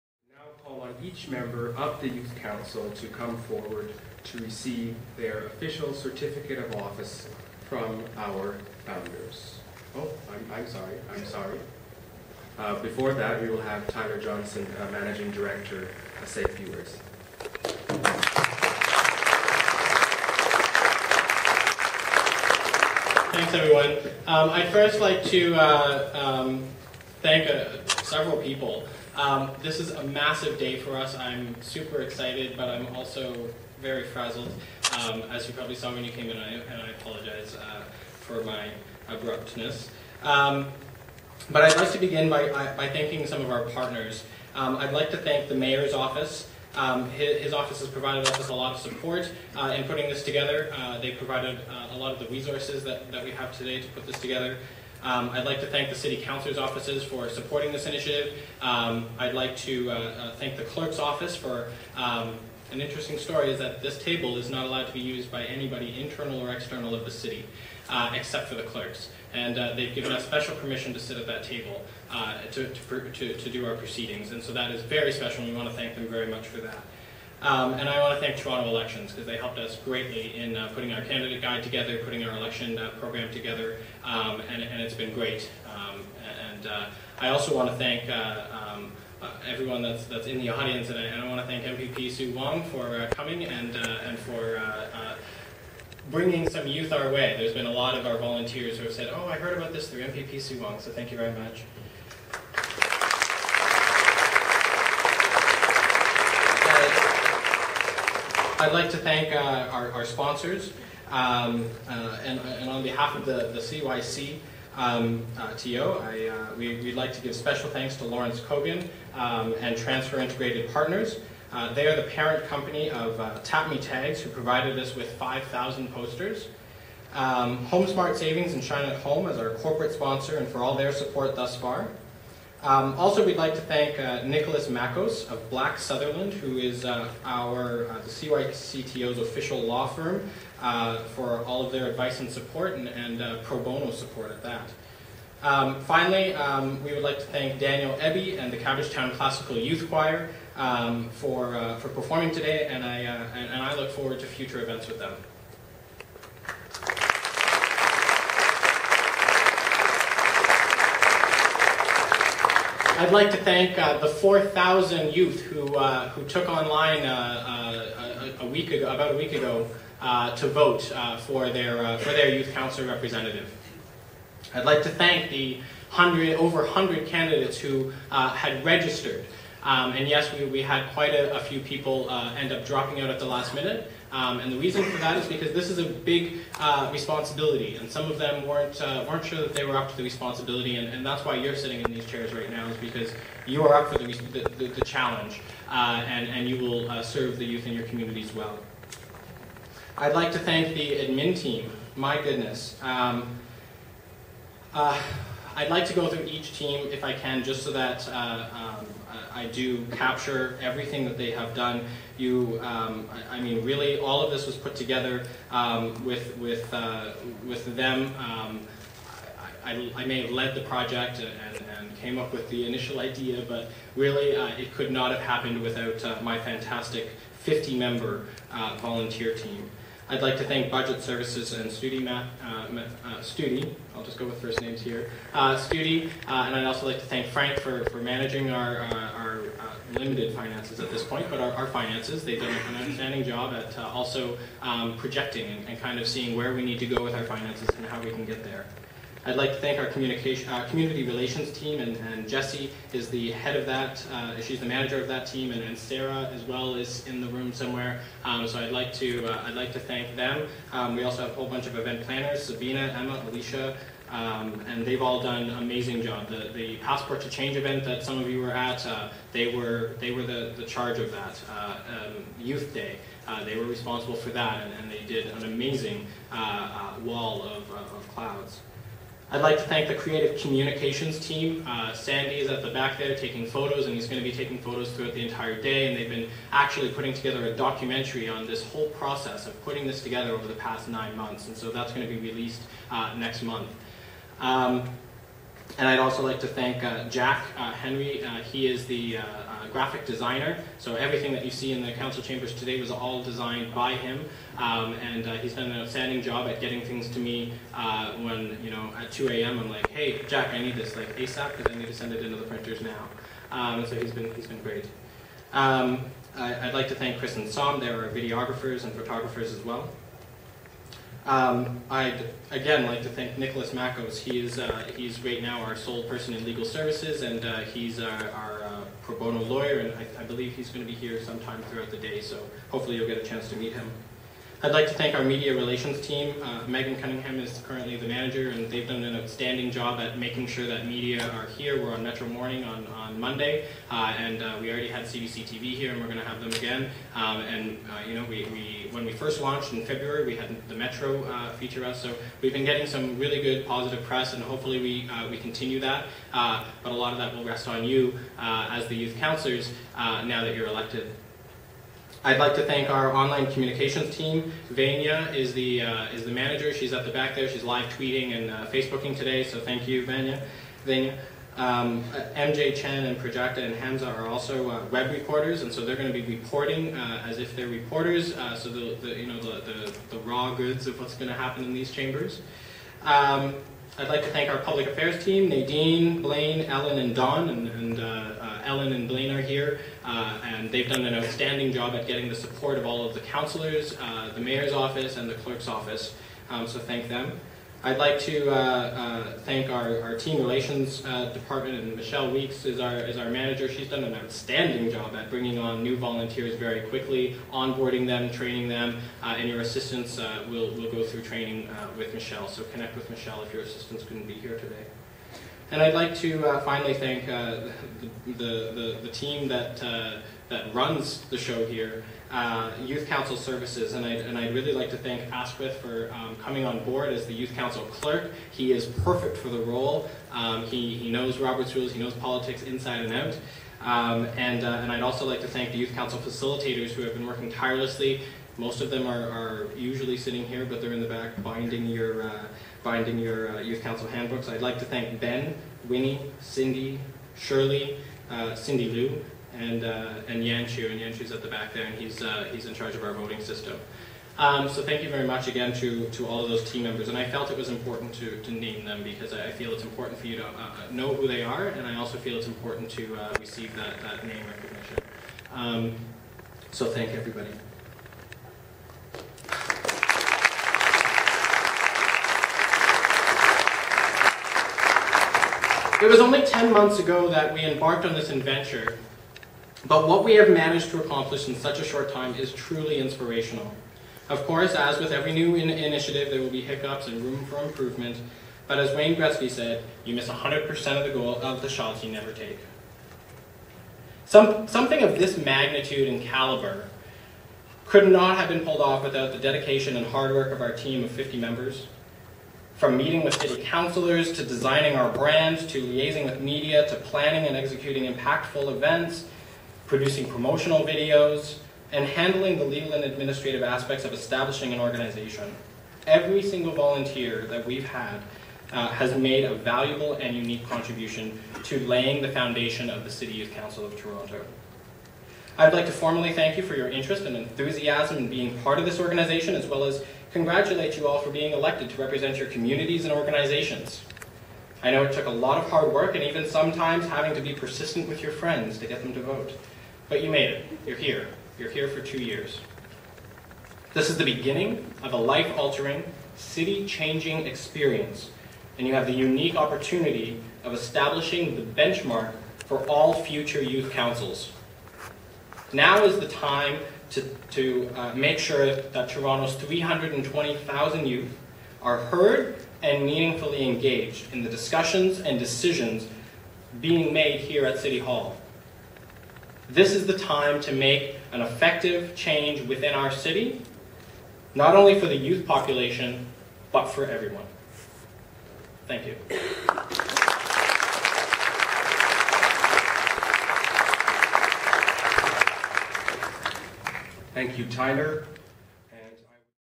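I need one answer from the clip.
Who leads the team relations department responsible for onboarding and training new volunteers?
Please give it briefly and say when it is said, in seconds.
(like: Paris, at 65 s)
Michelle Weeks, at 401 s.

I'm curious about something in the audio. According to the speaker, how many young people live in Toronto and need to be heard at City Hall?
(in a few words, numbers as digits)
320,000.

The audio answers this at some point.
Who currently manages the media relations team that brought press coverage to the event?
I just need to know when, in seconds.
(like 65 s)
336 s.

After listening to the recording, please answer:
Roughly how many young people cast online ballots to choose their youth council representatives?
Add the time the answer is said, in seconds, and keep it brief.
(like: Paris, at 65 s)
4,000, at 164 s.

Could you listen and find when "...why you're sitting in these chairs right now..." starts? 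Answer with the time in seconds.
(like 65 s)
191 s.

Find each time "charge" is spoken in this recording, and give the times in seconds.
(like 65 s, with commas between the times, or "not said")
270 s, 452 s.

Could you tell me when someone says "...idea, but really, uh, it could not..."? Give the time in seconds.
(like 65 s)
222 s.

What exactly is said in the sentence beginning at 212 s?
You, um, I, I, mean, really, all of this was put together um, with with uh, with them.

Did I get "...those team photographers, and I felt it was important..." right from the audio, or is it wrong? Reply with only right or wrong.
wrong.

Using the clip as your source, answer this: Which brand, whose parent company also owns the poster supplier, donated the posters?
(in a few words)
Tap Me Tags.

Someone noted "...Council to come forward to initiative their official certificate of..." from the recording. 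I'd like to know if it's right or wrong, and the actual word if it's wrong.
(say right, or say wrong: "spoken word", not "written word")
wrong: "receive", not "initiative".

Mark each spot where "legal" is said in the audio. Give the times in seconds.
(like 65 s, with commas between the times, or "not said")
326 s, 512 s.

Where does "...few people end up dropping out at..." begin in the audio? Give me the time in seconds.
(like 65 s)
181 s.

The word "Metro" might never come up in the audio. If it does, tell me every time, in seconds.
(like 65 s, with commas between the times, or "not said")
342 s, 350 s.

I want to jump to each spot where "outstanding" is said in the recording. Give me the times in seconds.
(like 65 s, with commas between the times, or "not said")
242 s, 305 s, 339 s, 391 s, 404 s.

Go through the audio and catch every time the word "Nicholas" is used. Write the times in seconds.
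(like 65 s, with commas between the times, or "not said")
134 s, 323 s.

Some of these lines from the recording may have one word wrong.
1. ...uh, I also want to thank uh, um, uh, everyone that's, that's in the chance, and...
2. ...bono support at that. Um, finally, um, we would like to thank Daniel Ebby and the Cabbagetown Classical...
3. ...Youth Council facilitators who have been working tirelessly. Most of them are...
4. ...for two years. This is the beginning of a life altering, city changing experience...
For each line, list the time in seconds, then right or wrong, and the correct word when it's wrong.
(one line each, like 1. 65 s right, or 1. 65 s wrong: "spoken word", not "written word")
1. 86 s wrong: "audience", not "chance"
2. 143 s right
3. 435 s right
4. 541 s right.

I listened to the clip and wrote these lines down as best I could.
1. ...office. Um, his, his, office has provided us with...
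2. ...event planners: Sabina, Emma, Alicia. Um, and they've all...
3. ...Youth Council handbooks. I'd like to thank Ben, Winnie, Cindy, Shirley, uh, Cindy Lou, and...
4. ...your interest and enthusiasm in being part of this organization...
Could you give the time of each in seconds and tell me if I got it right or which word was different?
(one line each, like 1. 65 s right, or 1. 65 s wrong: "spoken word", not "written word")
1. 45 s right
2. 261 s right
3. 443 s right
4. 526 s right.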